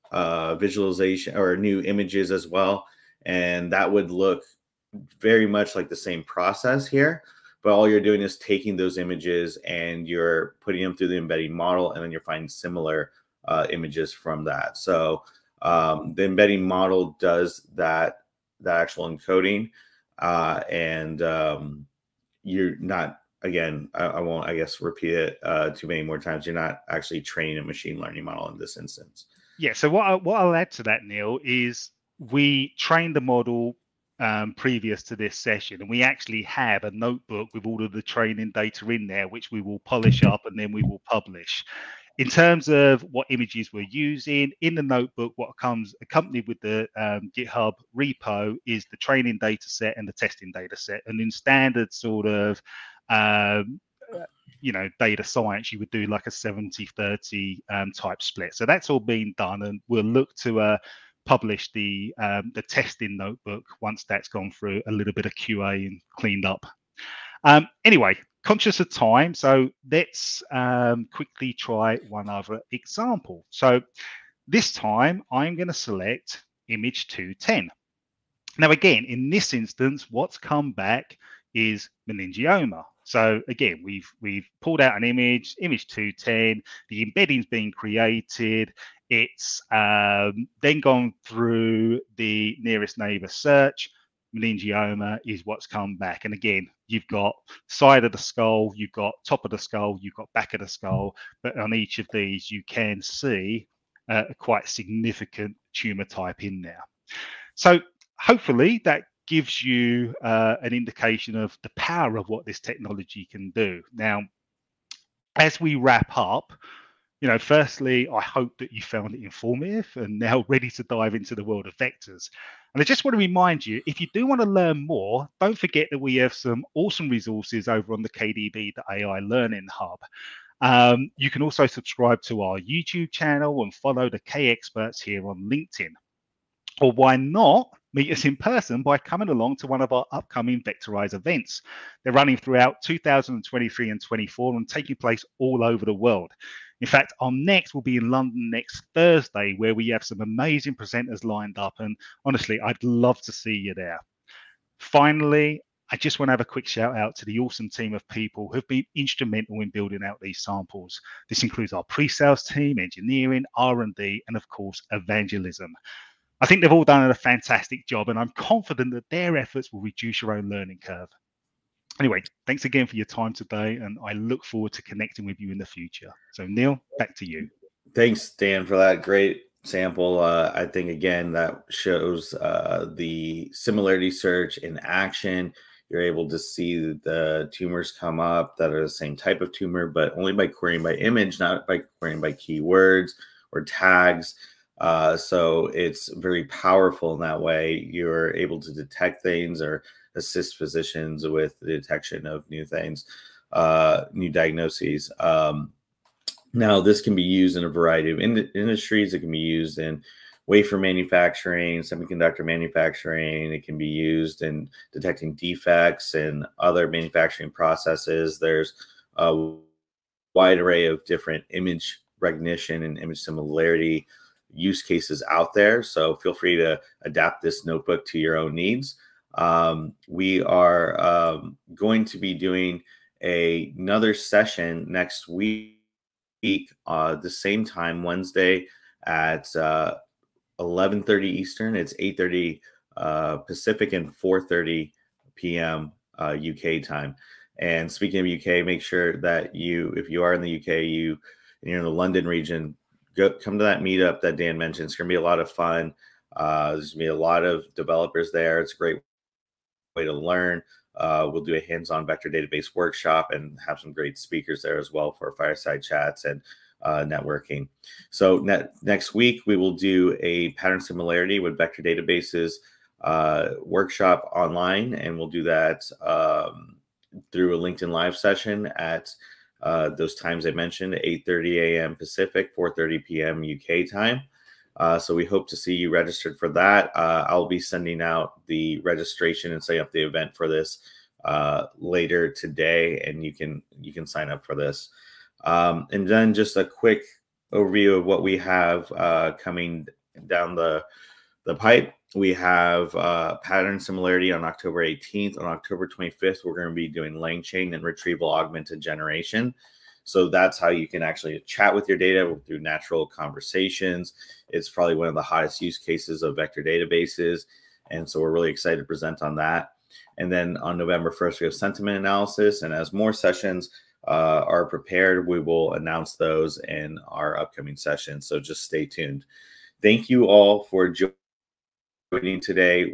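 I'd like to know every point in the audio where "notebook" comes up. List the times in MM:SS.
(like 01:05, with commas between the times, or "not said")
00:36, 00:44, 01:03, 03:47.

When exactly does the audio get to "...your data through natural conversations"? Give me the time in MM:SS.
05:11.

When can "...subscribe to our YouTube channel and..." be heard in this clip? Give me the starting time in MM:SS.
02:11.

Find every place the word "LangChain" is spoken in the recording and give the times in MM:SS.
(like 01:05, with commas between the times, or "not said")
05:07.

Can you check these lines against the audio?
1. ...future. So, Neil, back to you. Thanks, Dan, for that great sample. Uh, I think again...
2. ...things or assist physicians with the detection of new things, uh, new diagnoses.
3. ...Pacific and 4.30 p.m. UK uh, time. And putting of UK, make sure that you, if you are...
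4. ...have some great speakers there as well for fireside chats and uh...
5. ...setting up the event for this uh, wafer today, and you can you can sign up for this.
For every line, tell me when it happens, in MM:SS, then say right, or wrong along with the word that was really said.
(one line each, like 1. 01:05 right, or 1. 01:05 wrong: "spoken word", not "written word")
1. 02:55 right
2. 03:19 right
3. 04:03 wrong: "speaking", not "putting"
4. 04:23 right
5. 04:49 wrong: "later", not "wafer".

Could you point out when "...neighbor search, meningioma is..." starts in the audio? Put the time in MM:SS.
01:32.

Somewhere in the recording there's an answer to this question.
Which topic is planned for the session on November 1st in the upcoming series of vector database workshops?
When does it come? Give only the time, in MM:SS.
05:21.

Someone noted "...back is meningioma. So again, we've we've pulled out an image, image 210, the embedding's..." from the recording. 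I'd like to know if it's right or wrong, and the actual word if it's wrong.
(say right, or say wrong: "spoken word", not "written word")
right.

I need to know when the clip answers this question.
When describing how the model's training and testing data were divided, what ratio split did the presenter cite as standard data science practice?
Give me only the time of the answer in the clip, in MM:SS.
00:56.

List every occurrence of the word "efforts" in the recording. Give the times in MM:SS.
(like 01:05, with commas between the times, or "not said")
02:49.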